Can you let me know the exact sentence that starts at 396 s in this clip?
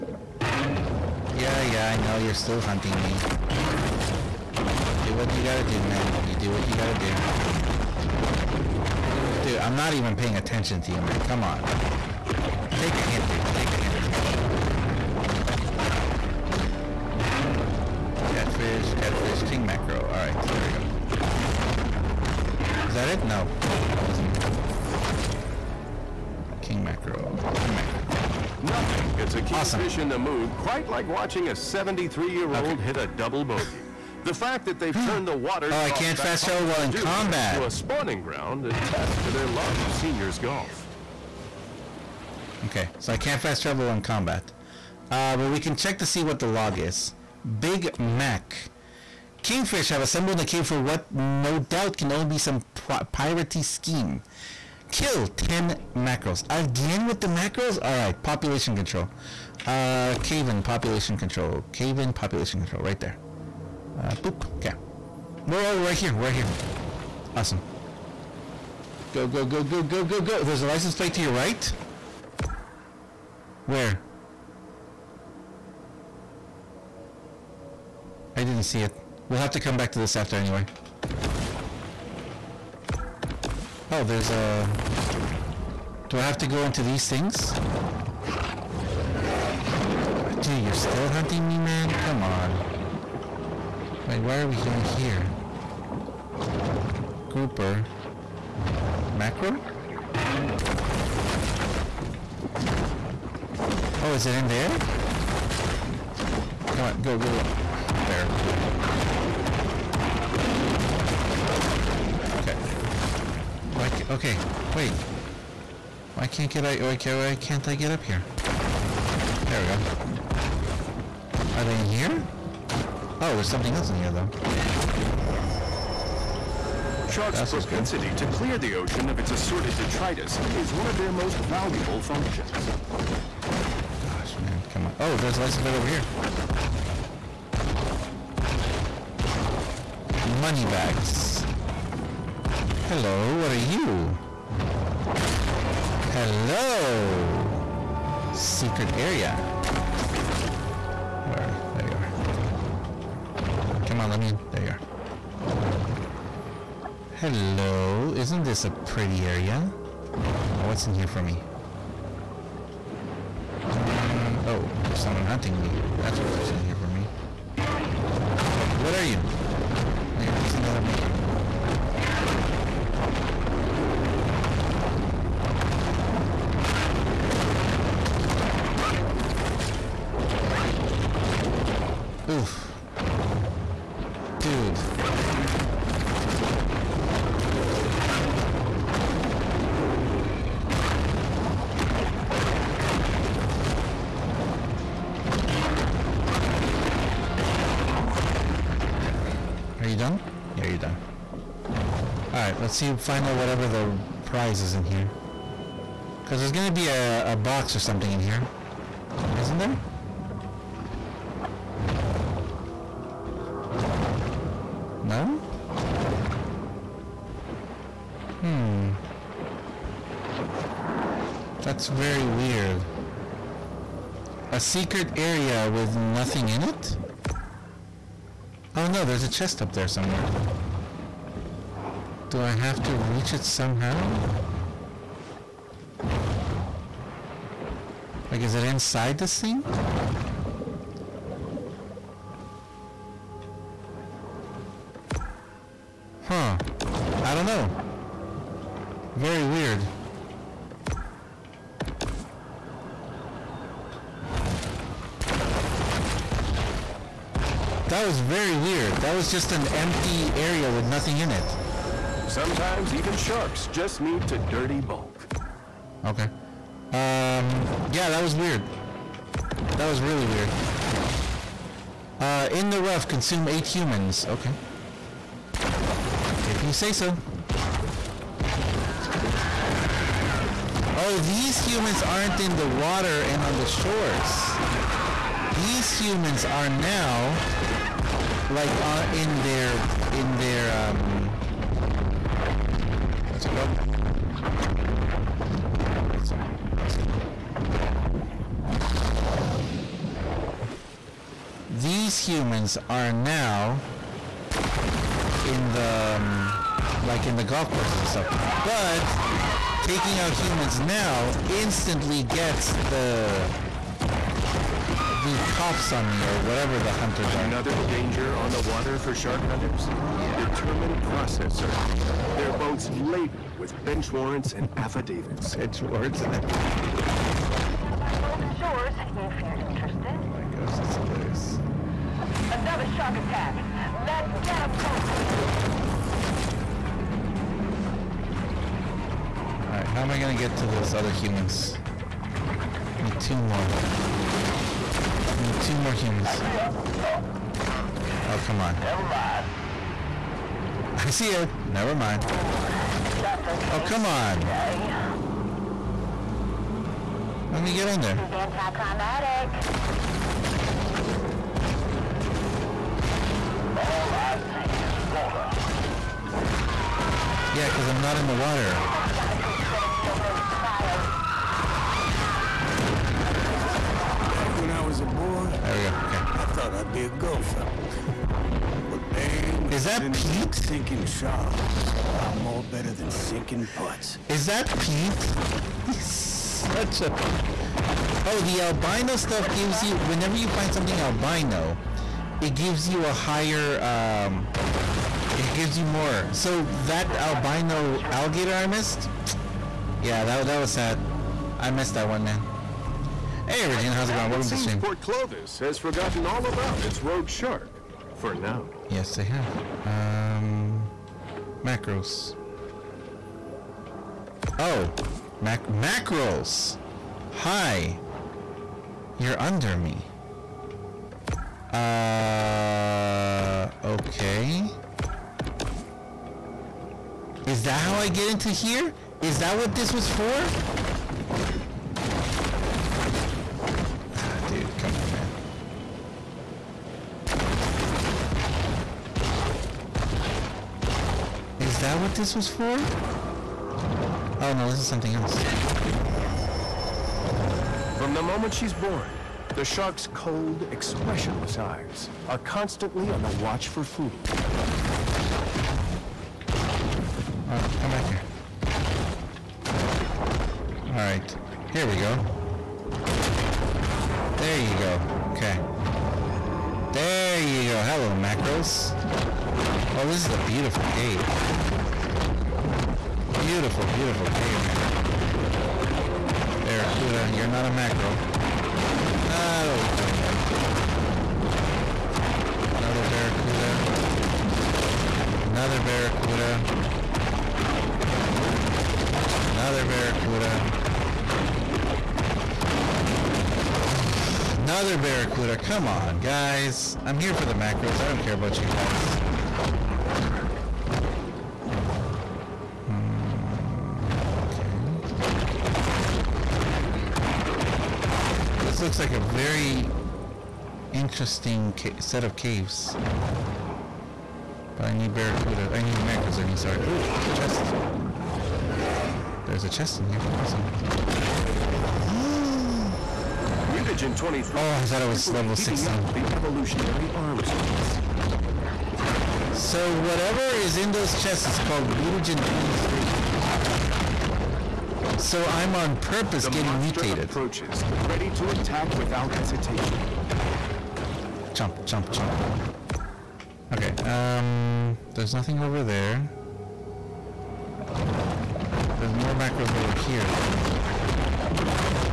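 So that albino alligator I missed?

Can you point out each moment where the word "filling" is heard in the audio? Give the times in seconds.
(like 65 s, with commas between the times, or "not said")
not said.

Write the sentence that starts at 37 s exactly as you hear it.
a spawning ground to their love of seniors golf.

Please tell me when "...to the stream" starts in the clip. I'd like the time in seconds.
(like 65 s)
404 s.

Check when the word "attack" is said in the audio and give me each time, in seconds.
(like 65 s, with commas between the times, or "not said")
333 s, 538 s.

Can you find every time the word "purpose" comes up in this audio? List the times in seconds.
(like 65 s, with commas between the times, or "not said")
535 s.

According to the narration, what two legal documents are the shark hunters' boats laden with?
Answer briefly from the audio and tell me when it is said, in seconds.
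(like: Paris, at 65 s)
Bench warrants and affidavits, at 325 s.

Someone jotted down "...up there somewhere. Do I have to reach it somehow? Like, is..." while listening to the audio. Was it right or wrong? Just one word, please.
right.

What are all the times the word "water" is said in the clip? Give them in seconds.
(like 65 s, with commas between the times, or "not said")
35 s, 282 s, 318 s, 368 s.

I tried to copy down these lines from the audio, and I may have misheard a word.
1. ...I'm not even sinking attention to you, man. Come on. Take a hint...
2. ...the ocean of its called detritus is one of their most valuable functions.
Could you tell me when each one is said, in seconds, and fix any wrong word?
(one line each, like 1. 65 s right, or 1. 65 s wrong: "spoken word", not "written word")
1. 9 s wrong: "paying", not "sinking"
2. 128 s wrong: "assorted", not "called".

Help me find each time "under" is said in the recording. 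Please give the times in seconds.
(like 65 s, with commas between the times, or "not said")
357 s, 419 s.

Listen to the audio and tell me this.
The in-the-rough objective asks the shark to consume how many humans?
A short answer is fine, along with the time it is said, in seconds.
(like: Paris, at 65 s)
8, at 273 s.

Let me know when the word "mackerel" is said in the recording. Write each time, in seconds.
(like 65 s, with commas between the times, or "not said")
19 s, 27 s, 415 s, 477 s, 497 s.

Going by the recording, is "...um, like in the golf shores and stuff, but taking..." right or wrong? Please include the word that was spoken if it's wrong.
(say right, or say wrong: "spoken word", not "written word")
wrong: "courses", not "shores".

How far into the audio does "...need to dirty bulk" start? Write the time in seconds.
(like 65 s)
263 s.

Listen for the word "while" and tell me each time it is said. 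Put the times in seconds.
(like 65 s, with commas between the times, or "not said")
36 s.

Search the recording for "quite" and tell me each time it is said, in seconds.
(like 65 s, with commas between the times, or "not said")
30 s.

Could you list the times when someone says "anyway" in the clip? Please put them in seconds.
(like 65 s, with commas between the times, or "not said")
80 s, 482 s.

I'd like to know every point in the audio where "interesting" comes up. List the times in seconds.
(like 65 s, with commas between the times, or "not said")
510 s.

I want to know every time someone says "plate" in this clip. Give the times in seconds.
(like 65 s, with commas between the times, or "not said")
70 s, 135 s.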